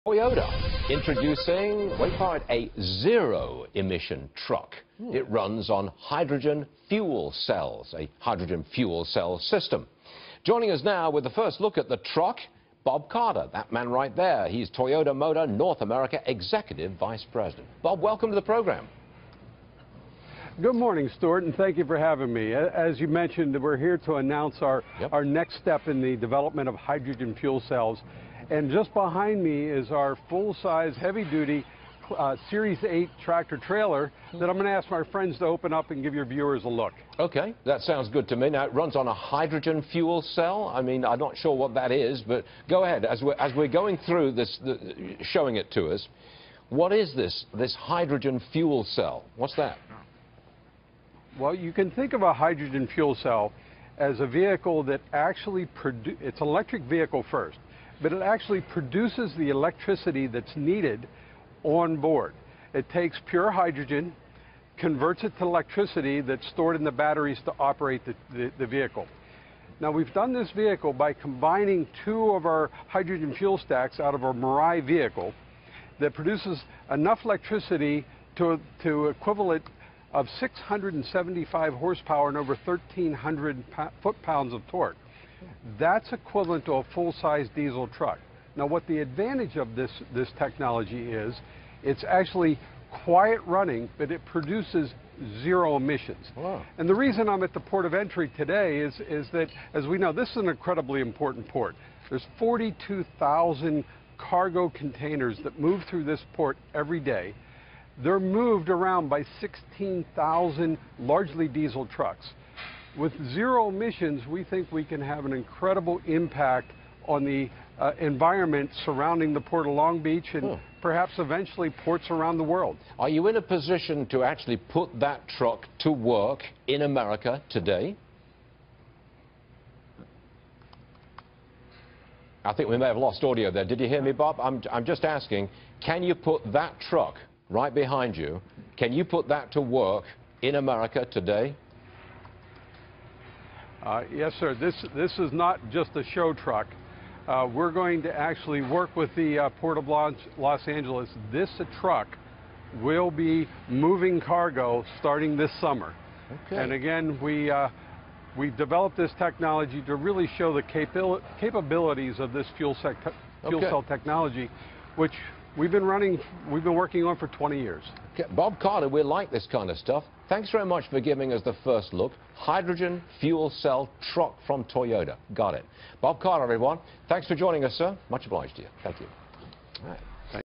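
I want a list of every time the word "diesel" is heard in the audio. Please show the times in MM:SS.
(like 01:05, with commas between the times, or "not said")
01:27, 01:51.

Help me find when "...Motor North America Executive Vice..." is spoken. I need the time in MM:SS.
00:15.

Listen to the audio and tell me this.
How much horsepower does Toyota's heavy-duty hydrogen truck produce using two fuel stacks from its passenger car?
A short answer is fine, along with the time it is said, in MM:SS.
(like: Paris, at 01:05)
675 horsepower, at 01:20.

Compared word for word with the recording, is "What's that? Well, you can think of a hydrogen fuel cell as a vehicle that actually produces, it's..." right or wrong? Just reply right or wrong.
right.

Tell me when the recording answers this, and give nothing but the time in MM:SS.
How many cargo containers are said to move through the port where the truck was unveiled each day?
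01:42.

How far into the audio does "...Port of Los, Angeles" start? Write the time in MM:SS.
02:29.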